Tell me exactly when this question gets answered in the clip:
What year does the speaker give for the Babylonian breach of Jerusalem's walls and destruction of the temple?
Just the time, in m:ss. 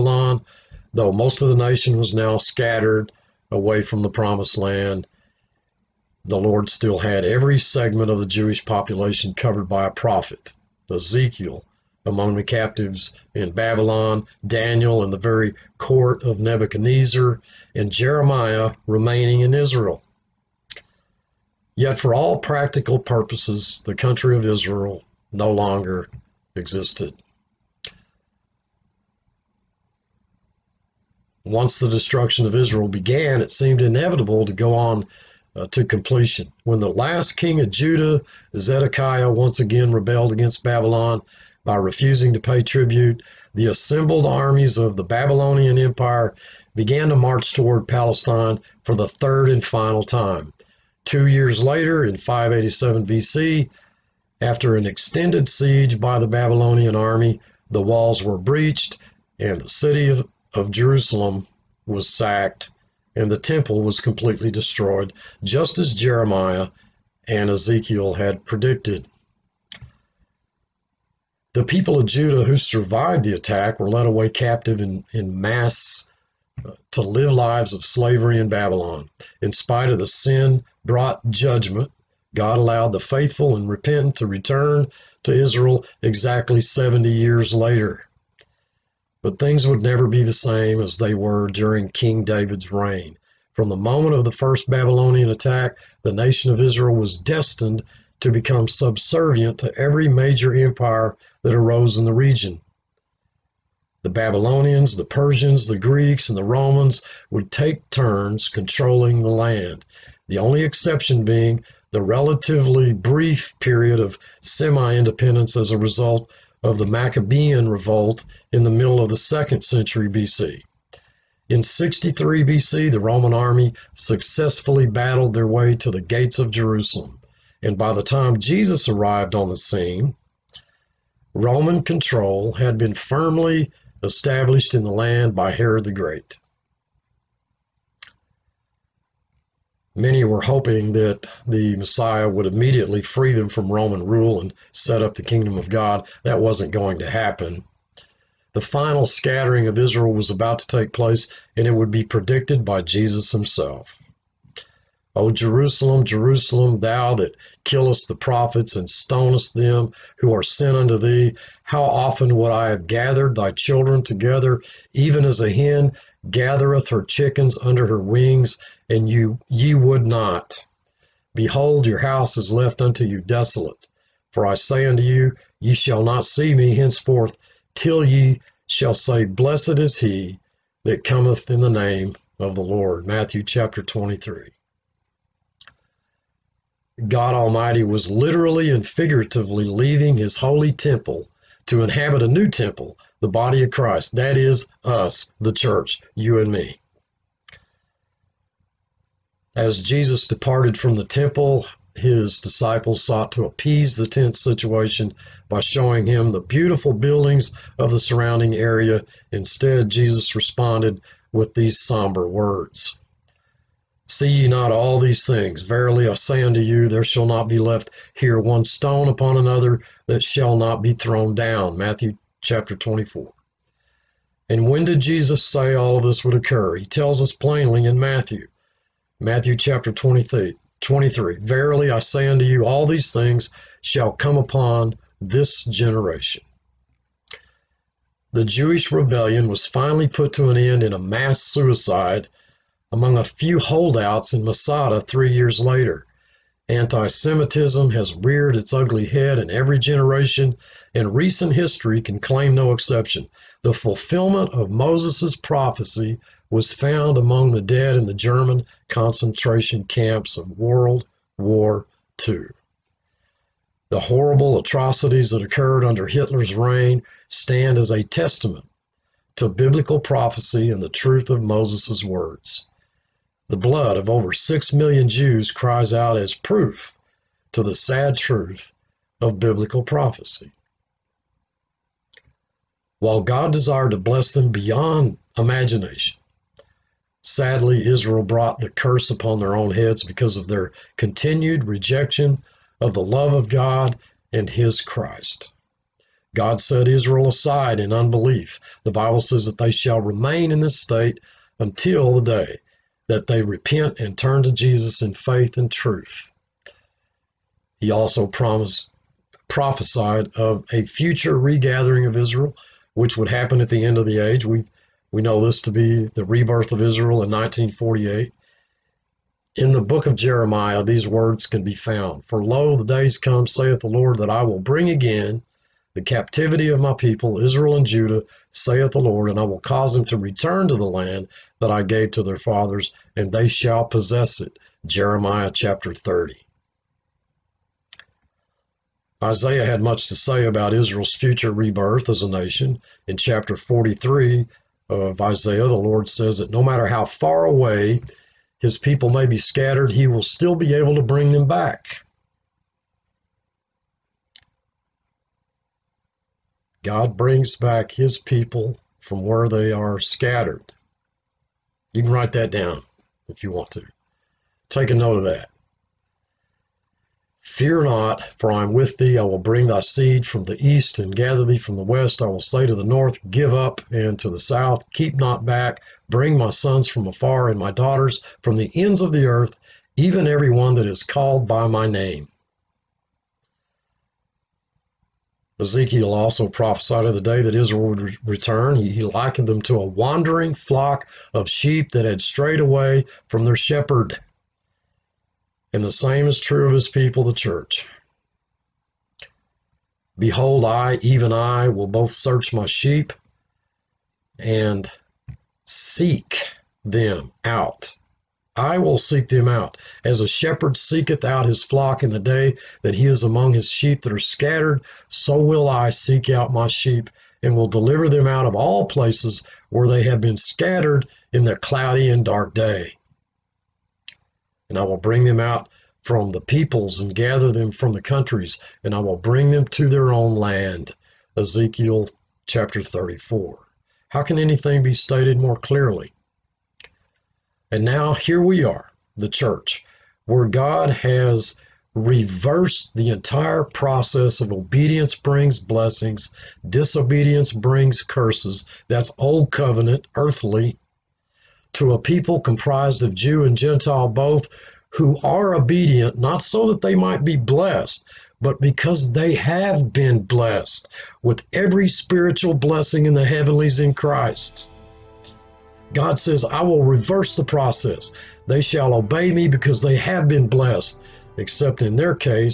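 0:52.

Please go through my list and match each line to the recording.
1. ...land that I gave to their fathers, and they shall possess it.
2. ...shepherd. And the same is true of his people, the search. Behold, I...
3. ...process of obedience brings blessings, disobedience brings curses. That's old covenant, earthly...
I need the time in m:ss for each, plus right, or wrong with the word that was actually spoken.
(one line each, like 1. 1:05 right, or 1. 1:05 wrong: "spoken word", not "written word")
1. 5:30 right
2. 6:33 wrong: "church", not "search"
3. 7:23 right.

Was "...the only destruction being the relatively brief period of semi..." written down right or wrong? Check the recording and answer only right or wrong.
wrong.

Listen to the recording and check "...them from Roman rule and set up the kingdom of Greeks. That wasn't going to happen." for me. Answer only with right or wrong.
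wrong.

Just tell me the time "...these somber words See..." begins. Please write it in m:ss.
3:31.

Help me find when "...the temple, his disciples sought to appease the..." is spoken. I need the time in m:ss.
3:20.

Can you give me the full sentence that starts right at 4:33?
The blood of over six million Jews cries out as proof to the sad truth of biblical prophecy.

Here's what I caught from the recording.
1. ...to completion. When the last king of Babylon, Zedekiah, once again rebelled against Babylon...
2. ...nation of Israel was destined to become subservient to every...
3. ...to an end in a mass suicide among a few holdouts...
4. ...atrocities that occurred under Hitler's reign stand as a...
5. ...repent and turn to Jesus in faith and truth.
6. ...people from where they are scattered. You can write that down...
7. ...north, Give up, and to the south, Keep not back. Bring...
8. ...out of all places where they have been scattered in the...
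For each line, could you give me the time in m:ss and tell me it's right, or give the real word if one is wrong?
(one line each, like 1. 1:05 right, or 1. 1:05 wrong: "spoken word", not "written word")
1. 0:35 wrong: "Judah", not "Babylon"
2. 1:36 right
3. 4:00 right
4. 4:24 right
5. 5:03 right
6. 5:58 right
7. 6:12 right
8. 6:58 right.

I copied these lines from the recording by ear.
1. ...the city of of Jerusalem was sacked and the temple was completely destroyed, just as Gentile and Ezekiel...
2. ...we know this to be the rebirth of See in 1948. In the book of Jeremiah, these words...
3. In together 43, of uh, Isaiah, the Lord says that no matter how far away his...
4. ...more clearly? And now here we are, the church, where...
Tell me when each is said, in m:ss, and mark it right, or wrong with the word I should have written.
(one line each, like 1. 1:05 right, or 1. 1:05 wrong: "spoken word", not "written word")
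1. 0:59 wrong: "Jeremiah", not "Gentile"
2. 5:15 wrong: "Israel", not "See"
3. 5:43 wrong: "chapter", not "together"
4. 7:15 right.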